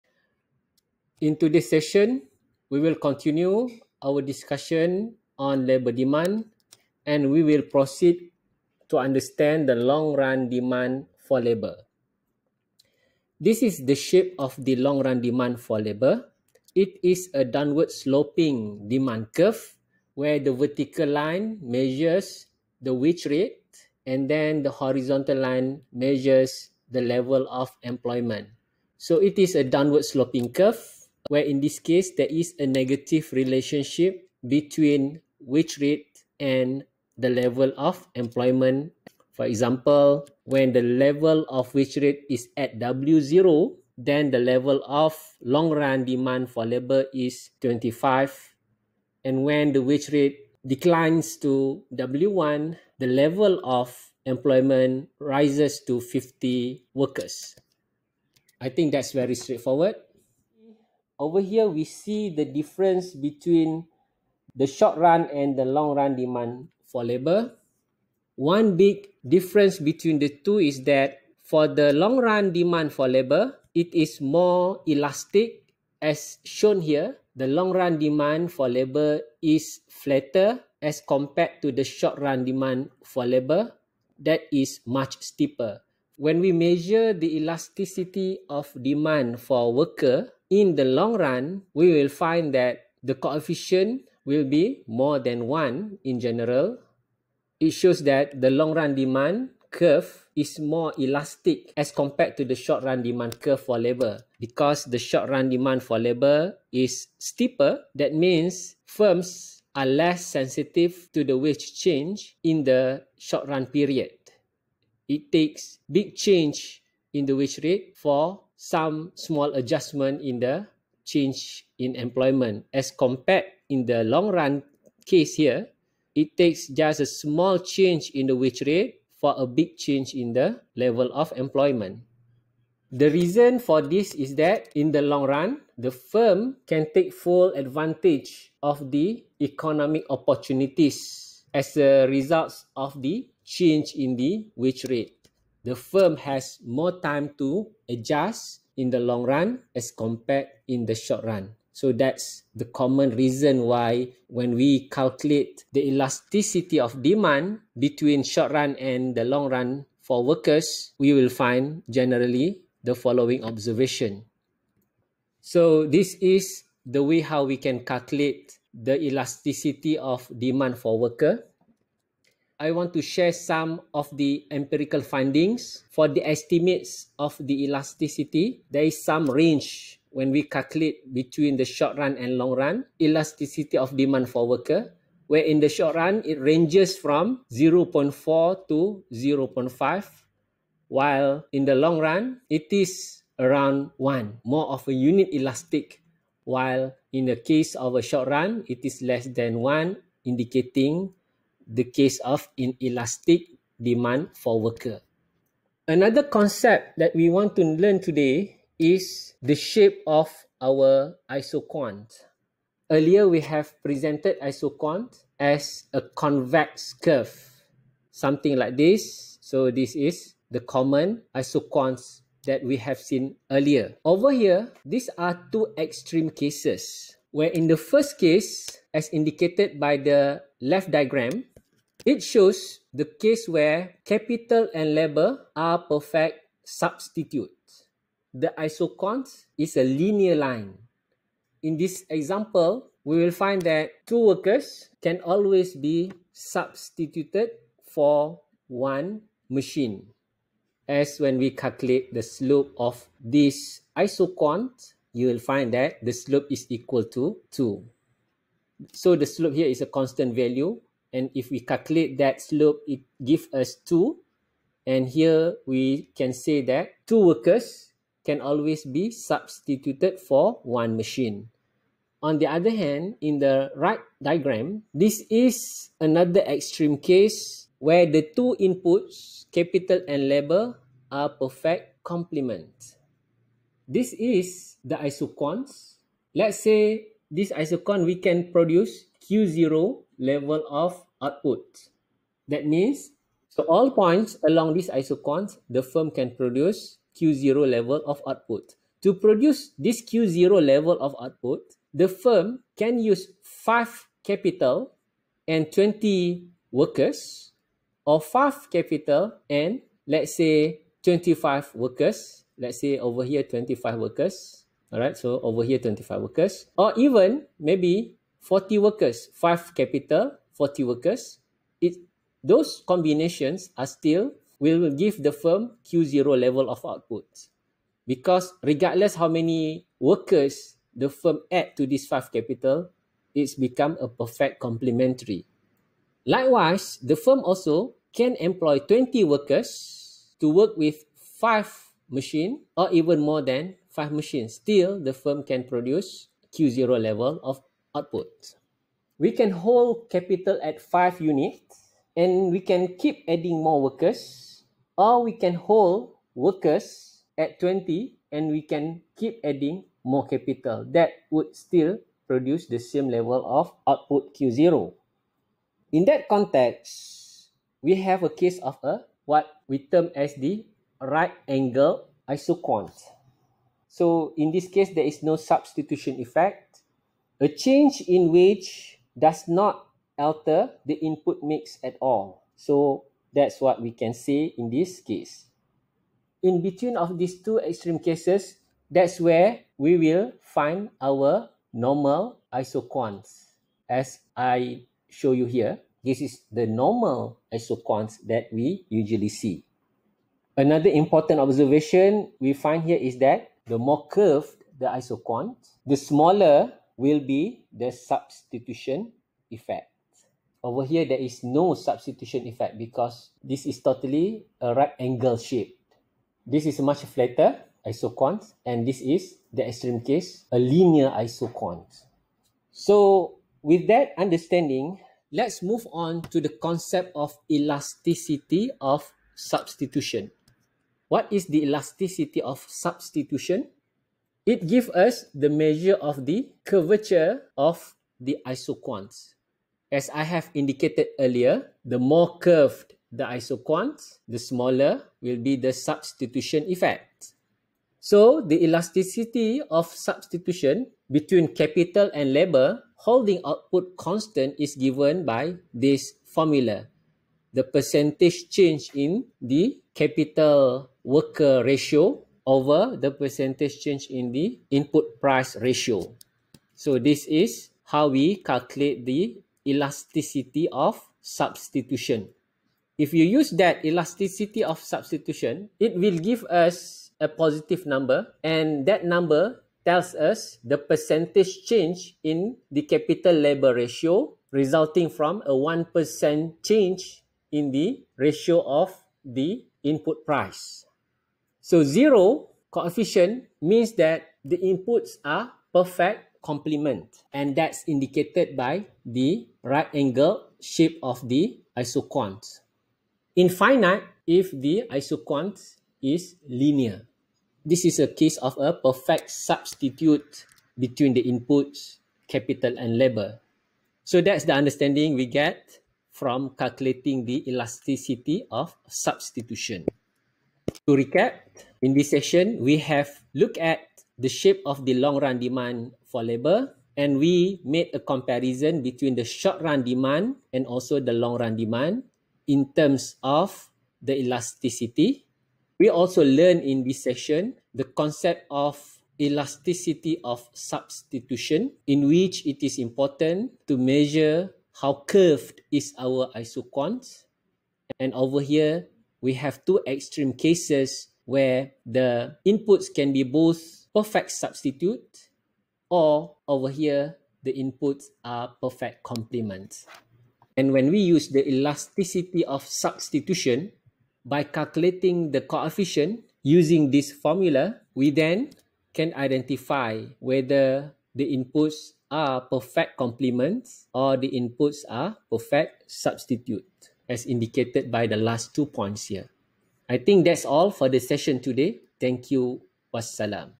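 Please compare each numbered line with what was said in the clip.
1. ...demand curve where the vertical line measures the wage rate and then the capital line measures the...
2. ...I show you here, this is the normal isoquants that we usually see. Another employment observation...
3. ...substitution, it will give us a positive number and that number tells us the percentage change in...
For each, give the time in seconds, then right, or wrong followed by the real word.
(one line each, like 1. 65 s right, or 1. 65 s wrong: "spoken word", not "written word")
1. 18 s wrong: "horizontal", not "capital"
2. 394 s wrong: "important", not "employment"
3. 474 s right.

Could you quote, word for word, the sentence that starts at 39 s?
For example, when the level of wage rate is at W0, then the level of long run demand for labor is 25.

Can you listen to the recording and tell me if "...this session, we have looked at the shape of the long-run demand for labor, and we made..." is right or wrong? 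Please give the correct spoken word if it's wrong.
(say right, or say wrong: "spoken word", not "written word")
right.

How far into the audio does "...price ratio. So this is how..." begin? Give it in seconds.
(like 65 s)
465 s.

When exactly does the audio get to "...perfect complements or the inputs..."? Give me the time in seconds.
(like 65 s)
572 s.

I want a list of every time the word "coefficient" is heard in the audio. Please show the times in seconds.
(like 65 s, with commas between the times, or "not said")
93 s, 492 s, 565 s.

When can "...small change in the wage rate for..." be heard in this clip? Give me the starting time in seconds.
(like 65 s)
127 s.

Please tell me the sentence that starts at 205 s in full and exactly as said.
Another concept that we want to learn today is the shape of our isoquant.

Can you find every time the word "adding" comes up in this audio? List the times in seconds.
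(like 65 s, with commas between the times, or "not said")
353 s, 359 s.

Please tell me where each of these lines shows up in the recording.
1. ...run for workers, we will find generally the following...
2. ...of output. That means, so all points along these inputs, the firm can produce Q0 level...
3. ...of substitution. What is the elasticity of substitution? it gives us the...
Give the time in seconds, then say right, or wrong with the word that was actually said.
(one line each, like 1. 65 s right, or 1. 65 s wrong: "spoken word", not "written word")
1. 159 s right
2. 290 s wrong: "isoquants", not "inputs"
3. 428 s right.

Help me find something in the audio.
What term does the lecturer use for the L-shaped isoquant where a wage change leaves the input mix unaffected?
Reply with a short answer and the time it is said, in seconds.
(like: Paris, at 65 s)
right angle isoquant, at 370 s.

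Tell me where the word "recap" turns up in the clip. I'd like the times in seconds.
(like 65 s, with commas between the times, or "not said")
520 s.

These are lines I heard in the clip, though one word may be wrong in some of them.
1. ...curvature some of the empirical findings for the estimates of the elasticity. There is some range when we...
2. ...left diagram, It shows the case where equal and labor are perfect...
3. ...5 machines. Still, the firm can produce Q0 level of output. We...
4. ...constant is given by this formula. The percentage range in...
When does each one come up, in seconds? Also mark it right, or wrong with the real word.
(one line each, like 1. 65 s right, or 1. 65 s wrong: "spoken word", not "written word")
1. 173 s wrong: "share", not "curvature"
2. 230 s wrong: "capital", not "equal"
3. 343 s right
4. 453 s wrong: "change", not "range".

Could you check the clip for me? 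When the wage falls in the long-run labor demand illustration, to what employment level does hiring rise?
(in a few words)
50 workers.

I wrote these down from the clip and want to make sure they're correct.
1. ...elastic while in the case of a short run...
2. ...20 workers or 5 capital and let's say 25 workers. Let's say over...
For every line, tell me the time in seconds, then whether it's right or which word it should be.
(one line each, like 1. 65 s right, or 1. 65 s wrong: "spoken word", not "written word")
1. 195 s right
2. 305 s right.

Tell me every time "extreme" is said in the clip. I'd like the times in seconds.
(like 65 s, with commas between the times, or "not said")
225 s, 276 s, 387 s, 419 s, 549 s.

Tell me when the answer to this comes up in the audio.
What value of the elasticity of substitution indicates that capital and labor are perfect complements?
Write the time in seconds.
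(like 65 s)
491 s.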